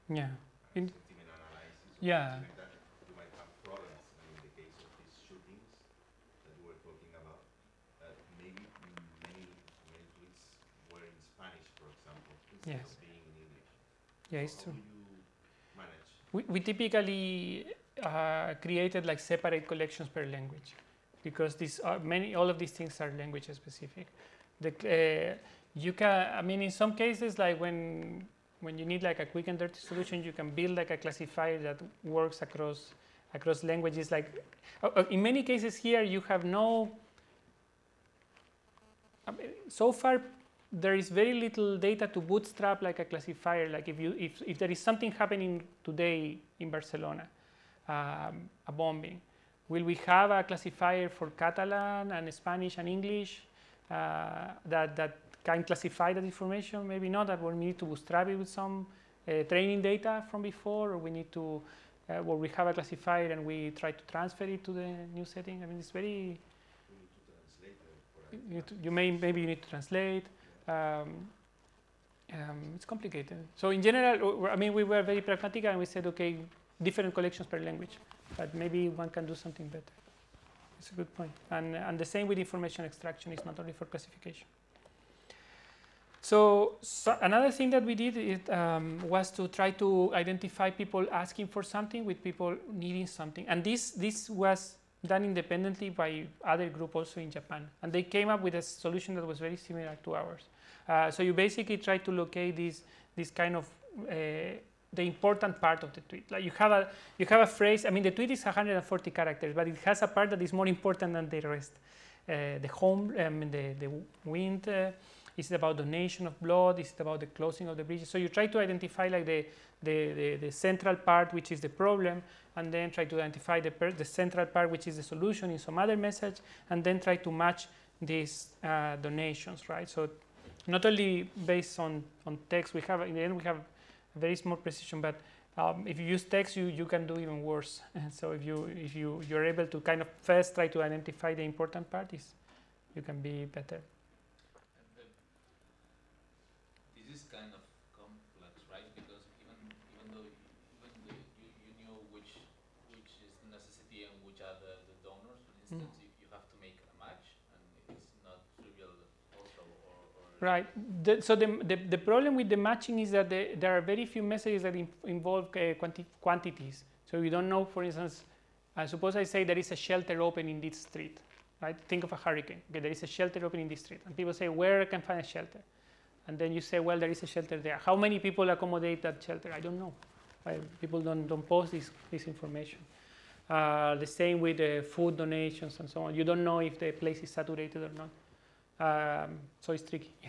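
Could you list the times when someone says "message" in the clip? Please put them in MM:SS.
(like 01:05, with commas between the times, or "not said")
02:05, 02:44.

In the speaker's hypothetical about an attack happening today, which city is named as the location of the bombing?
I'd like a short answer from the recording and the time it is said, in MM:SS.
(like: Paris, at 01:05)
Barcelona, at 00:46.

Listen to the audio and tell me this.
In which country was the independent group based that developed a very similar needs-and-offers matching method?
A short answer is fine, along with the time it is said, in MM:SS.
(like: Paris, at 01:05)
Japan, at 01:37.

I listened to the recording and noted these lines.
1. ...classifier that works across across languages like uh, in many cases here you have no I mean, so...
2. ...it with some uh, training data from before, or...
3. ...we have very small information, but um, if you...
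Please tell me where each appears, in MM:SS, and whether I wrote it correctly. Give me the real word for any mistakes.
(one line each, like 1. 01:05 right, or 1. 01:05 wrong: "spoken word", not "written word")
1. 00:30 right
2. 00:58 right
3. 02:13 wrong: "precision", not "information".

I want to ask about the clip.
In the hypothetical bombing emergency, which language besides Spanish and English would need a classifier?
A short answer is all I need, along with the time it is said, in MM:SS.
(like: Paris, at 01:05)
Catalan, at 00:51.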